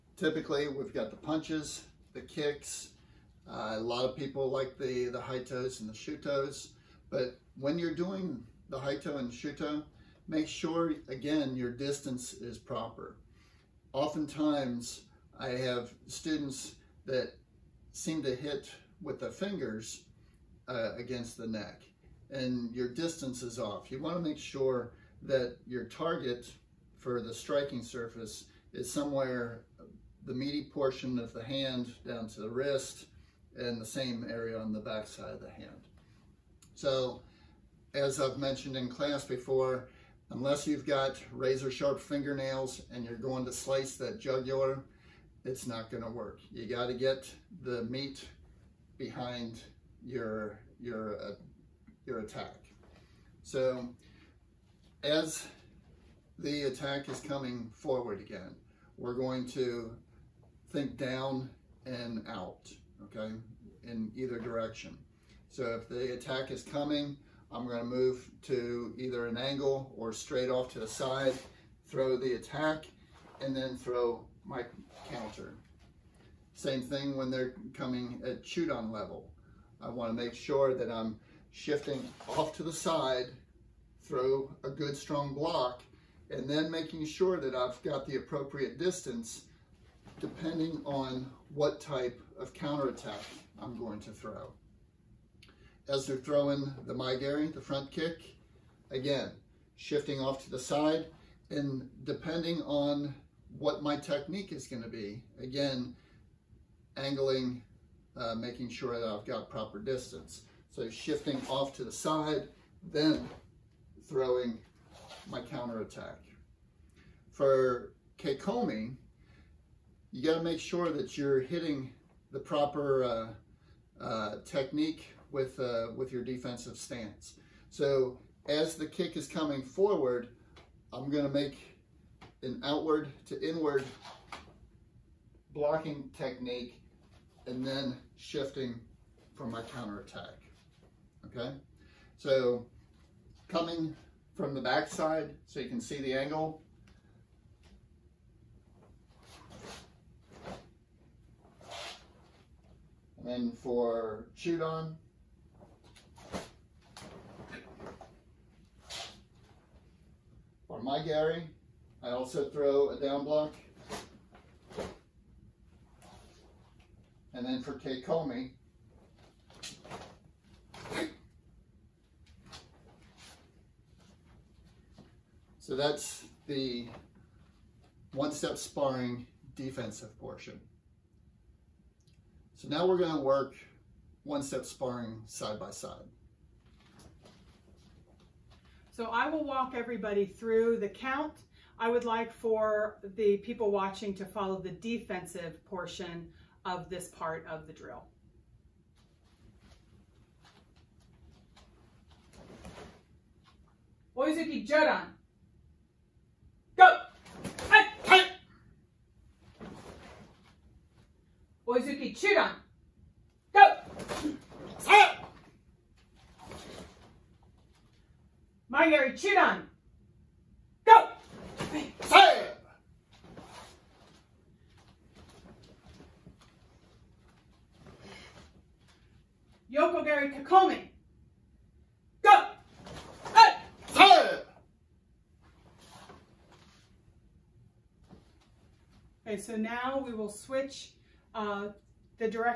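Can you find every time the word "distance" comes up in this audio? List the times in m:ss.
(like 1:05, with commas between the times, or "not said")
0:11, 0:22, 1:28, 1:49.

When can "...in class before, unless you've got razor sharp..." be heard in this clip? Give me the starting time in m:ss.
0:38.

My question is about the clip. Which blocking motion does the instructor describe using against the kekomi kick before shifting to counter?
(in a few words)
outward to inward.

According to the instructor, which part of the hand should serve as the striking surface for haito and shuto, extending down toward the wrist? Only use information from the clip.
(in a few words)
meaty portion of the hand.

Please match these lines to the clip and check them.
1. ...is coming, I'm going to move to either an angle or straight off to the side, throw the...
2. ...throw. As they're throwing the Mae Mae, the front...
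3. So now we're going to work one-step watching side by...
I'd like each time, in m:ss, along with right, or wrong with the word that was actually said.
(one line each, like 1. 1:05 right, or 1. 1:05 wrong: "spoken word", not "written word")
1. 1:06 right
2. 1:34 wrong: "Geri", not "Mae"
3. 3:02 wrong: "sparring", not "watching".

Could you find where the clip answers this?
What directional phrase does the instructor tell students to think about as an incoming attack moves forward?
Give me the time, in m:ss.
1:00.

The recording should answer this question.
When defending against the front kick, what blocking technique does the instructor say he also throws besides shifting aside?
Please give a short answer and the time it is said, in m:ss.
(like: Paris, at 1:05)
down block, at 2:42.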